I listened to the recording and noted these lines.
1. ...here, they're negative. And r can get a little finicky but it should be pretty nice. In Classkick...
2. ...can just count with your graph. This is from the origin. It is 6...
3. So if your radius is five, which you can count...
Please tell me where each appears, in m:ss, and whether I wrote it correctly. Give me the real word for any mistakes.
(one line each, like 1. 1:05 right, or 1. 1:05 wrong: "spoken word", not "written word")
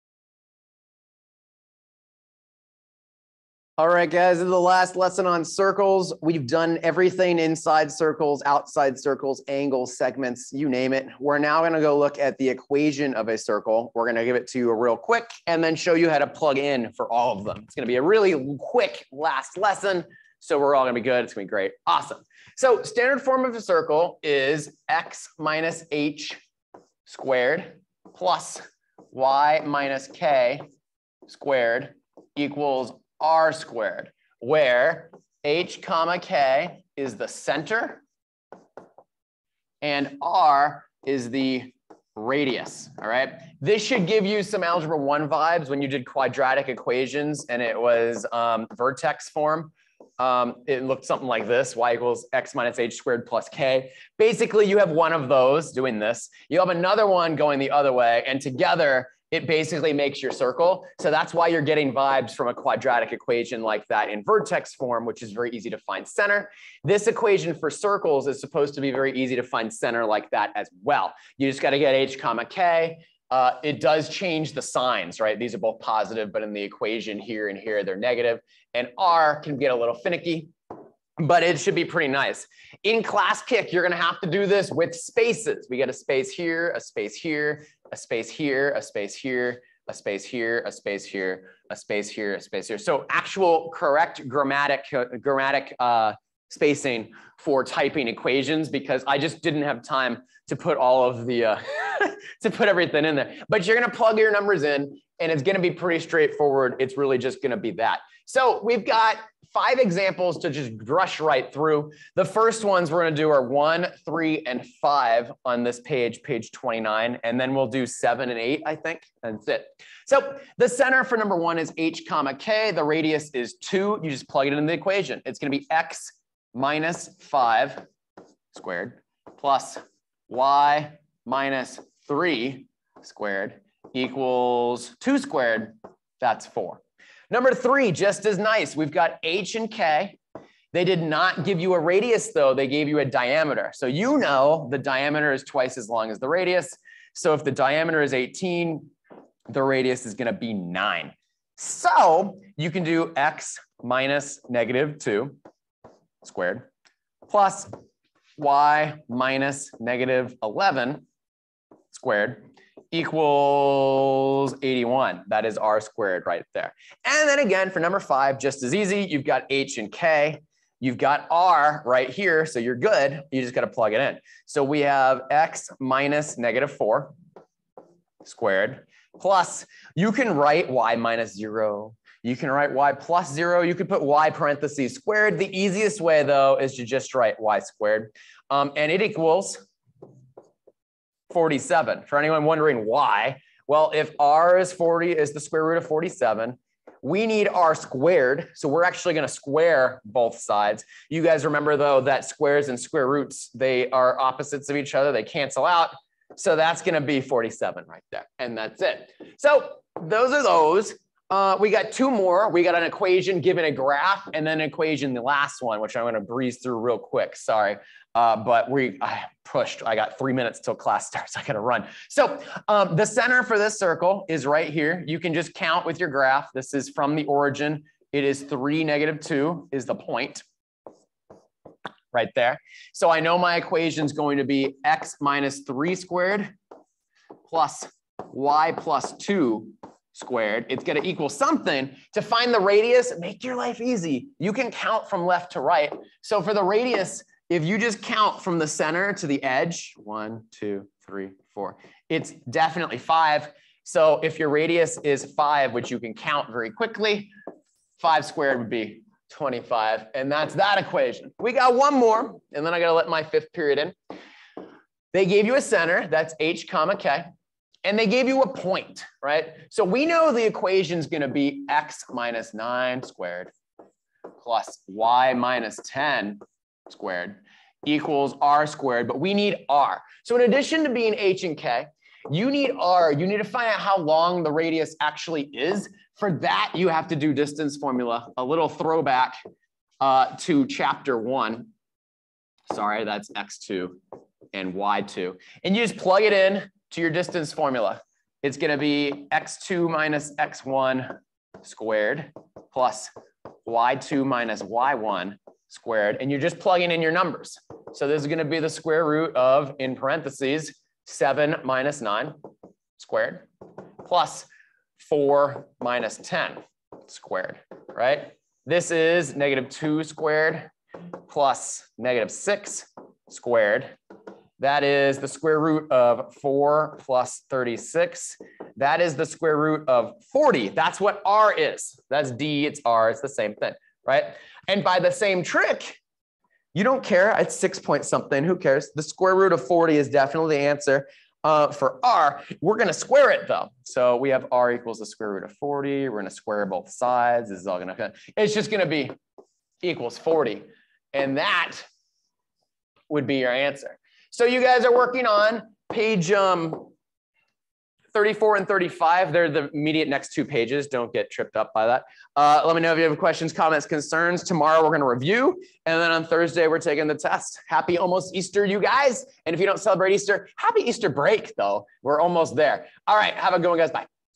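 1. 1:17 right
2. 3:45 wrong: "3", not "6"
3. 4:13 right.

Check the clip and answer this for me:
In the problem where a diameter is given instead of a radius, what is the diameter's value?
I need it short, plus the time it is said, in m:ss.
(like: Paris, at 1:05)
18, at 2:28.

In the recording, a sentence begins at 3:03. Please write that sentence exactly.
You could put y parentheses squared.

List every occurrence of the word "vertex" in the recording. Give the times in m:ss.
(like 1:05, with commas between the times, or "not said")
0:48, 1:04.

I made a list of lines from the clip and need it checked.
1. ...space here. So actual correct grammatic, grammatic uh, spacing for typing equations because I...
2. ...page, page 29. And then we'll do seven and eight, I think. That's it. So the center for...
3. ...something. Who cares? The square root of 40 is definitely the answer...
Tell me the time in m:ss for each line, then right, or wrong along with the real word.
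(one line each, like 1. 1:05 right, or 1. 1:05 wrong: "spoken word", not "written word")
1. 1:32 right
2. 1:55 right
3. 5:38 right.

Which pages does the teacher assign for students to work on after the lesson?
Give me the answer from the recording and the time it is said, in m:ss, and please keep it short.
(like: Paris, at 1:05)
34 and 35, at 5:58.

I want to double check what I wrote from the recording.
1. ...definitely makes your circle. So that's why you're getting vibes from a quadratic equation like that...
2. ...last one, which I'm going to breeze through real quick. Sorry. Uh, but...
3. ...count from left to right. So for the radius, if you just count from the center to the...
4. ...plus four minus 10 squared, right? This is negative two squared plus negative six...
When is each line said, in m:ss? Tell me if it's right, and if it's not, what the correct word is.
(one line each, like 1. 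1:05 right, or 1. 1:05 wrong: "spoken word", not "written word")
1. 0:59 wrong: "basically", not "definitely"
2. 3:35 right
3. 4:04 right
4. 5:14 right.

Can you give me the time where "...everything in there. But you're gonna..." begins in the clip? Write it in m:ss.
1:42.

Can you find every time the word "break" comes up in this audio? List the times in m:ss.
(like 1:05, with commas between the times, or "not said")
6:11.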